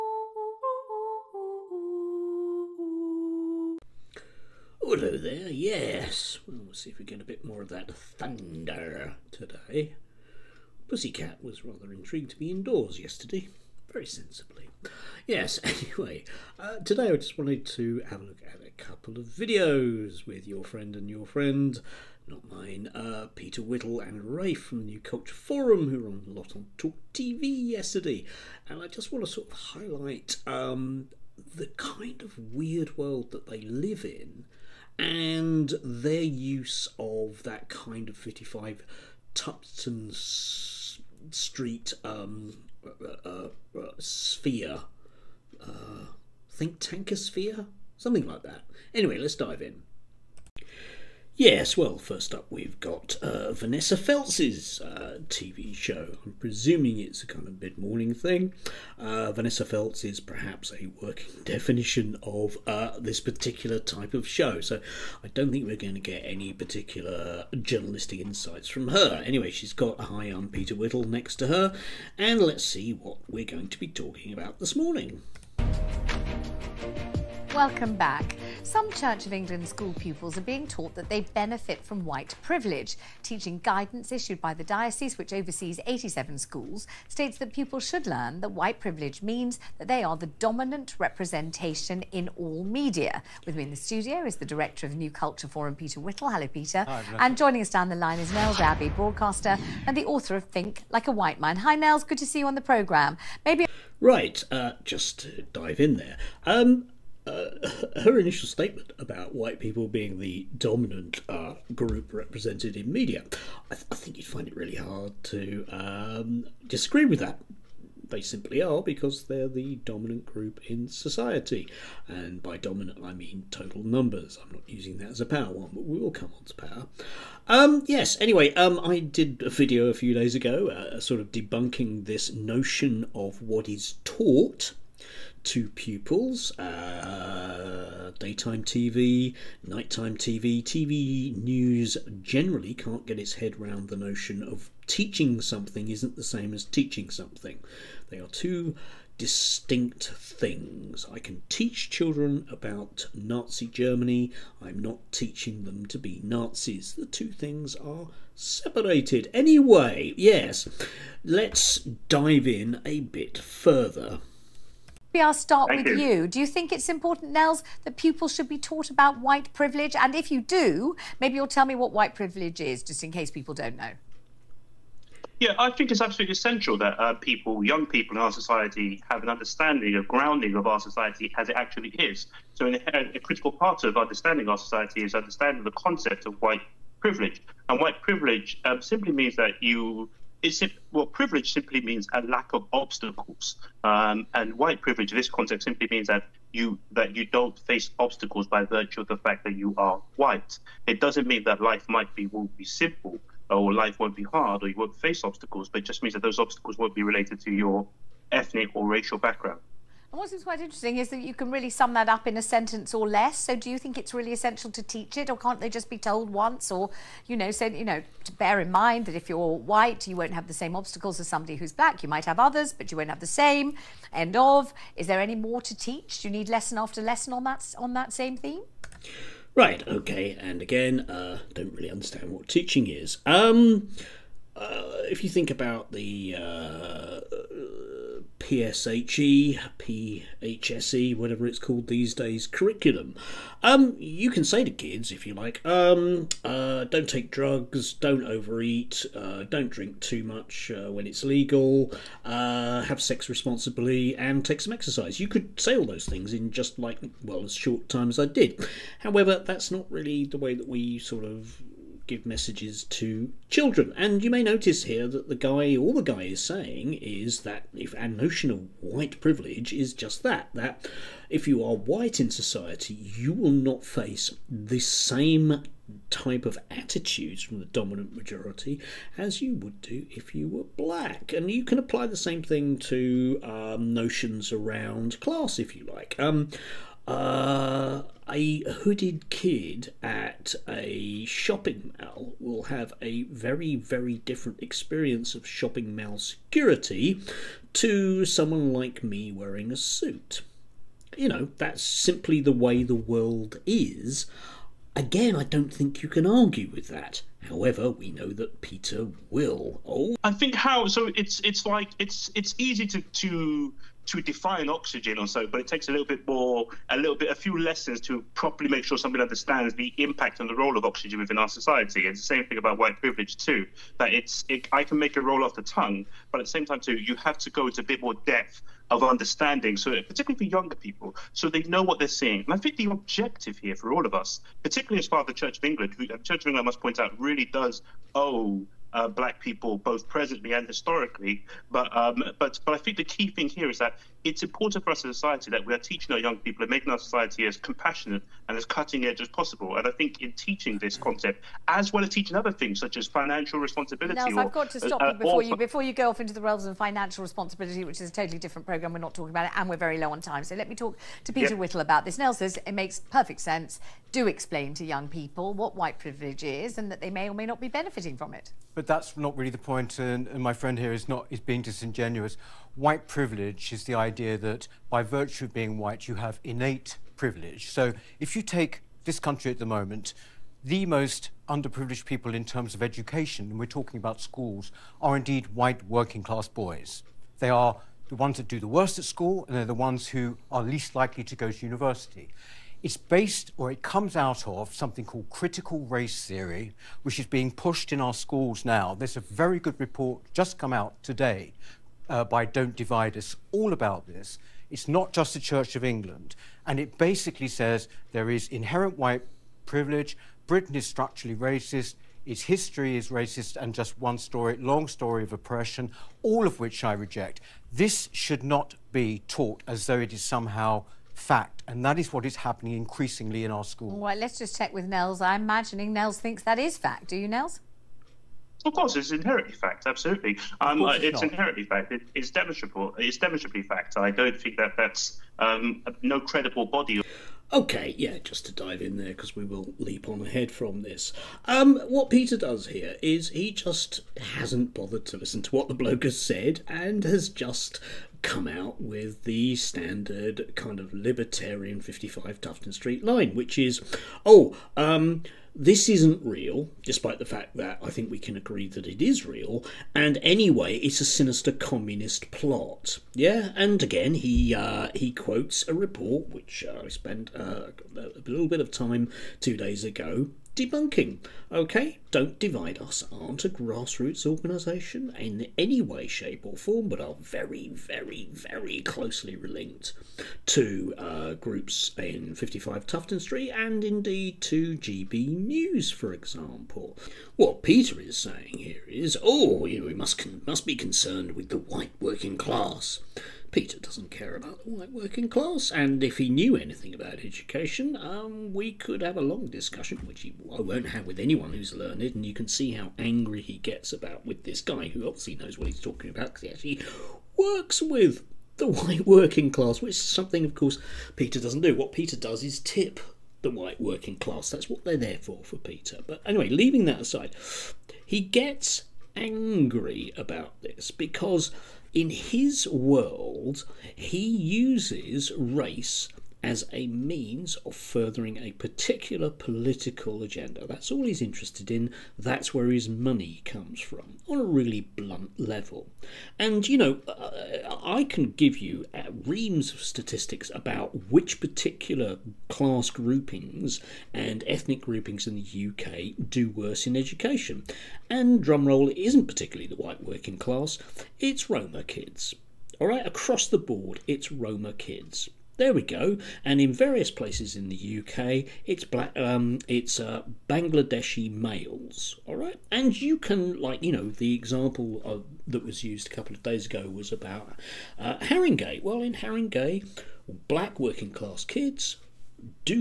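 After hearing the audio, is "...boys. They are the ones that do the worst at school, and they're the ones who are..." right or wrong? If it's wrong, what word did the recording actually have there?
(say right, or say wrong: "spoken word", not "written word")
right.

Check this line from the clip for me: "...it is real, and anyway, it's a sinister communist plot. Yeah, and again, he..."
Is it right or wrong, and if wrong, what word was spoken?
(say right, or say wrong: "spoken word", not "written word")
right.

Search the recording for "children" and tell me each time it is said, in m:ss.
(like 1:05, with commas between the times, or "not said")
2:31, 4:23.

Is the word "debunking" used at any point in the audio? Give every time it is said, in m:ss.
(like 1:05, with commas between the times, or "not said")
2:11, 7:50.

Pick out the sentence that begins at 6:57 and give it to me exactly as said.
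This should not be taught as though it is somehow fact, and that is what is happening increasingly in our schools.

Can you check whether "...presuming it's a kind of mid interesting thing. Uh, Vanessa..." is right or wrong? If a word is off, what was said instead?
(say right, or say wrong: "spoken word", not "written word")
wrong: "morning", not "interesting".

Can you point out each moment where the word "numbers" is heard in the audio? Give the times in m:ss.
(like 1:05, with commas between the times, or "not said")
2:03.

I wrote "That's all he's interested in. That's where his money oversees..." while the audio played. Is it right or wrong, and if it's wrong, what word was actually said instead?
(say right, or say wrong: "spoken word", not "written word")
wrong: "comes", not "oversees".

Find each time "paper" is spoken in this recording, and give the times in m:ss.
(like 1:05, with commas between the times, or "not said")
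not said.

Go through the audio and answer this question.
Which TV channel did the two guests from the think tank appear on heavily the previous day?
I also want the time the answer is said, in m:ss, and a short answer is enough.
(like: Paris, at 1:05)
Talk TV, at 0:26.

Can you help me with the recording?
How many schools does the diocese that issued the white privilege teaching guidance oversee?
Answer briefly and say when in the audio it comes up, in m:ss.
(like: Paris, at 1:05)
87, at 1:25.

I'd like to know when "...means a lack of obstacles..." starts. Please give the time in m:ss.
3:11.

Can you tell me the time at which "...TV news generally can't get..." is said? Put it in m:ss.
2:20.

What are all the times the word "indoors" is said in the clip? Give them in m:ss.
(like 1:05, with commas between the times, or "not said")
0:12.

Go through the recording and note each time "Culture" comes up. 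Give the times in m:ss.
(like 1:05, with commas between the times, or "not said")
0:25, 1:35.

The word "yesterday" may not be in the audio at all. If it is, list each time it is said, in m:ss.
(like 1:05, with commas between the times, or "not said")
0:12, 0:27.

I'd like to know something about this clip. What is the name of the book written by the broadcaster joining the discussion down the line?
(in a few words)
Think Like a White Man.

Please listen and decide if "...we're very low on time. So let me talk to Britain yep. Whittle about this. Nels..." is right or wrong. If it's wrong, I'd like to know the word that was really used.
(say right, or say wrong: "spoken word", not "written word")
wrong: "Peter", not "Britain".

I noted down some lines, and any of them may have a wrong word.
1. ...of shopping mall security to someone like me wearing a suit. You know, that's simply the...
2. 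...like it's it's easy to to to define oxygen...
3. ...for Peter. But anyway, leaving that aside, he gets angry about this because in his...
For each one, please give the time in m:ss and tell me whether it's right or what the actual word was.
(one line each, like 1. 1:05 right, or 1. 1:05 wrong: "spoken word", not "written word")
1. 4:55 right
2. 5:11 right
3. 8:35 right.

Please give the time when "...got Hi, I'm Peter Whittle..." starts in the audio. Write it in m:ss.
1:09.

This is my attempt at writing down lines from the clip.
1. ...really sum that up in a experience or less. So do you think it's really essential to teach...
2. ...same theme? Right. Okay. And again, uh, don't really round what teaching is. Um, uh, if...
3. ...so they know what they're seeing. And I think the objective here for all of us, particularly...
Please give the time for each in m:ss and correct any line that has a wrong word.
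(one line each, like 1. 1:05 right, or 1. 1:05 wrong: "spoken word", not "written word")
1. 3:31 wrong: "sentence", not "experience"
2. 3:48 wrong: "understand", not "round"
3. 5:31 right.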